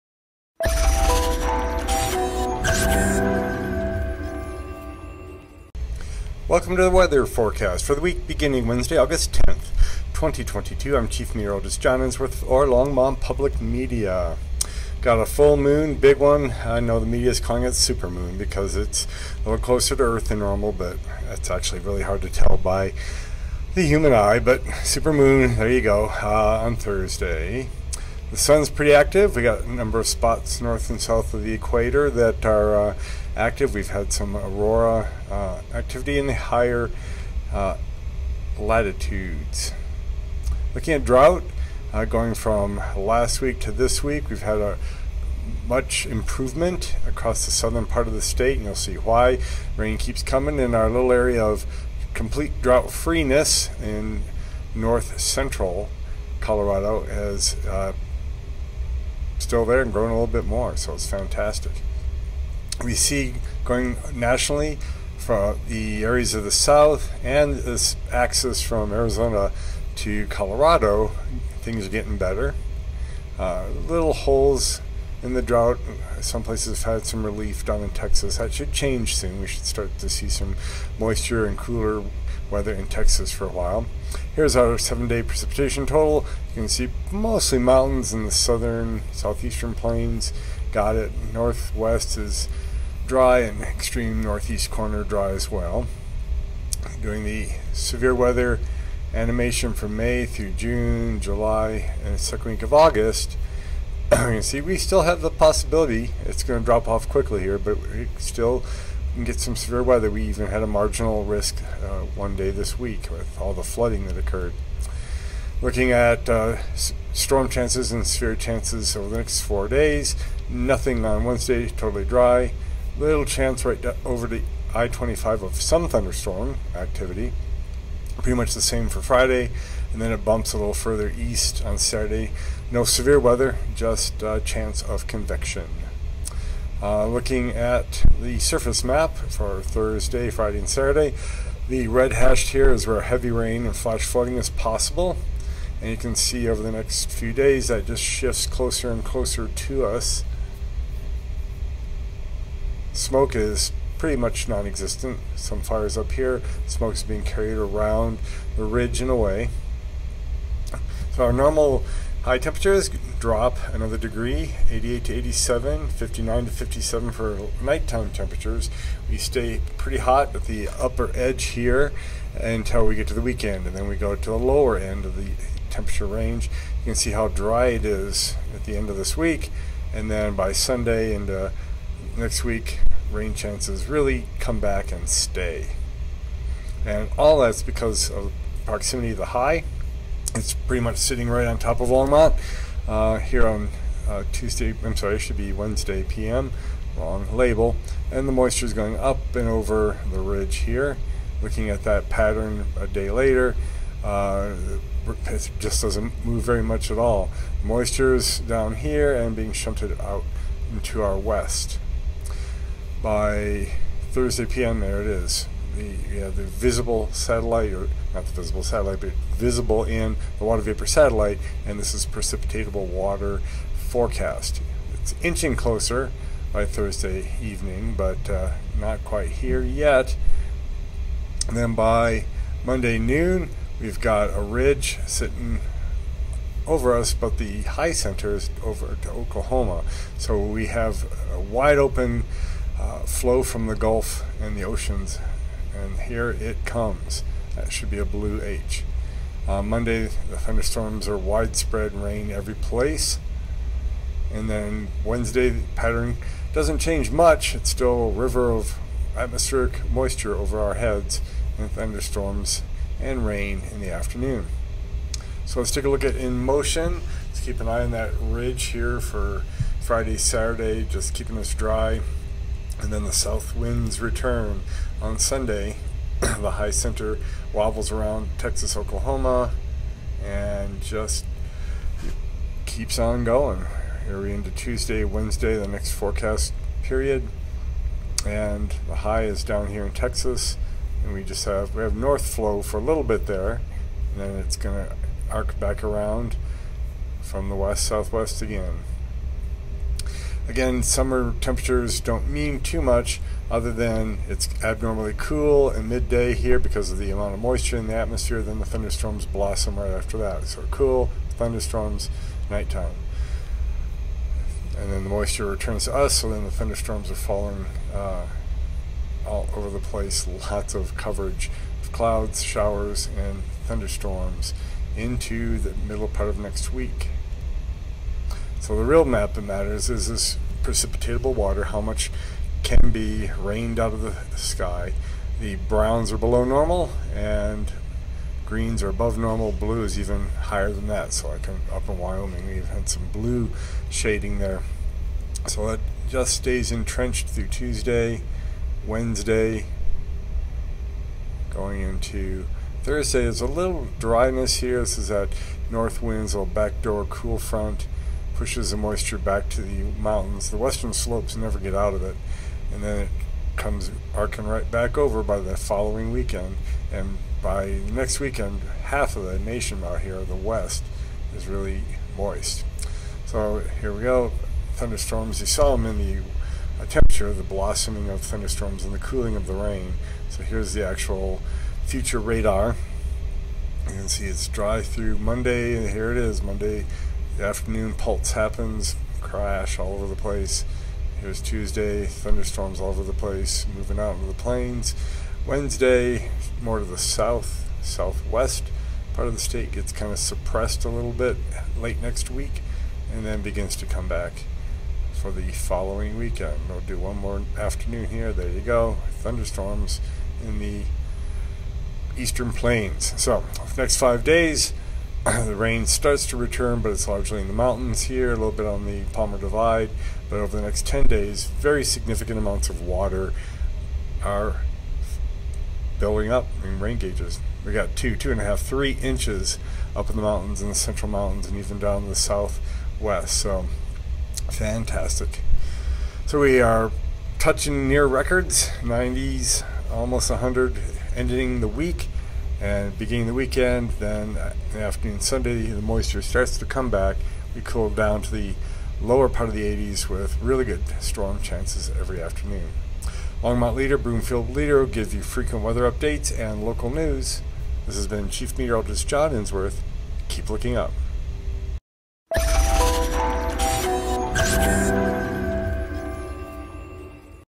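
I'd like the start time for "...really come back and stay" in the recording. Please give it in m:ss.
3:03.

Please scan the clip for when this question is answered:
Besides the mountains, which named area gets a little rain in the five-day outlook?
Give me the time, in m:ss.
6:59.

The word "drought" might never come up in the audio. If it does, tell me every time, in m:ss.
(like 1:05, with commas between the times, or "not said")
0:41, 0:52, 1:15.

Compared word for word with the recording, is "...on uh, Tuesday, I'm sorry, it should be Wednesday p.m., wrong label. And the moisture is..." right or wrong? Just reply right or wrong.
right.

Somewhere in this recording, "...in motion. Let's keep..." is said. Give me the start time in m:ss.
4:26.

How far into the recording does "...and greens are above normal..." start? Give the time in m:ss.
5:37.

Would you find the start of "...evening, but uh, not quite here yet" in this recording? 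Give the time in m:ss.
3:47.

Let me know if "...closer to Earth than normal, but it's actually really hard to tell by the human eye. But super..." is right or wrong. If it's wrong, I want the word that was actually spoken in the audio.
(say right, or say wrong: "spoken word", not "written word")
right.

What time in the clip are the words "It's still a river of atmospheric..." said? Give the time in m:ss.
4:17.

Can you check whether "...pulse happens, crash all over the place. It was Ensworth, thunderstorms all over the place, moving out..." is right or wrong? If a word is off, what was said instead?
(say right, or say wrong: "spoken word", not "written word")
wrong: "Tuesday", not "Ensworth".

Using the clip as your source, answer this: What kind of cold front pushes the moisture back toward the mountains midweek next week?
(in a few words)
backdoor cool front.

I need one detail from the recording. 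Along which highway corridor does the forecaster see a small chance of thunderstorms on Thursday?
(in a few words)
I-25.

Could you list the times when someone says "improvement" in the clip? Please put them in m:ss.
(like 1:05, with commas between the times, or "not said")
0:46.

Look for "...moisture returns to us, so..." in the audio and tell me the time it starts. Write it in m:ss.
5:15.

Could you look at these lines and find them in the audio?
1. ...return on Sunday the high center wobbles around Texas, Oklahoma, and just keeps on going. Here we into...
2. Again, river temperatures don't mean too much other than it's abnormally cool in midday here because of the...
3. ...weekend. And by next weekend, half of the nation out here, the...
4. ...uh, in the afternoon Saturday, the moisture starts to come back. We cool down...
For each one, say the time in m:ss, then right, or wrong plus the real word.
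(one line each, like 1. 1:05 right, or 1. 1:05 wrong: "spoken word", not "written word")
1. 4:33 right
2. 5:00 wrong: "summer", not "river"
3. 6:06 right
4. 7:24 wrong: "Sunday", not "Saturday".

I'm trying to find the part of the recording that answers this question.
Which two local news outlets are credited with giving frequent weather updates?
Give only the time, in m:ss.
7:33.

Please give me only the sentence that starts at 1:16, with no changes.
Some places have had some relief down in Texas.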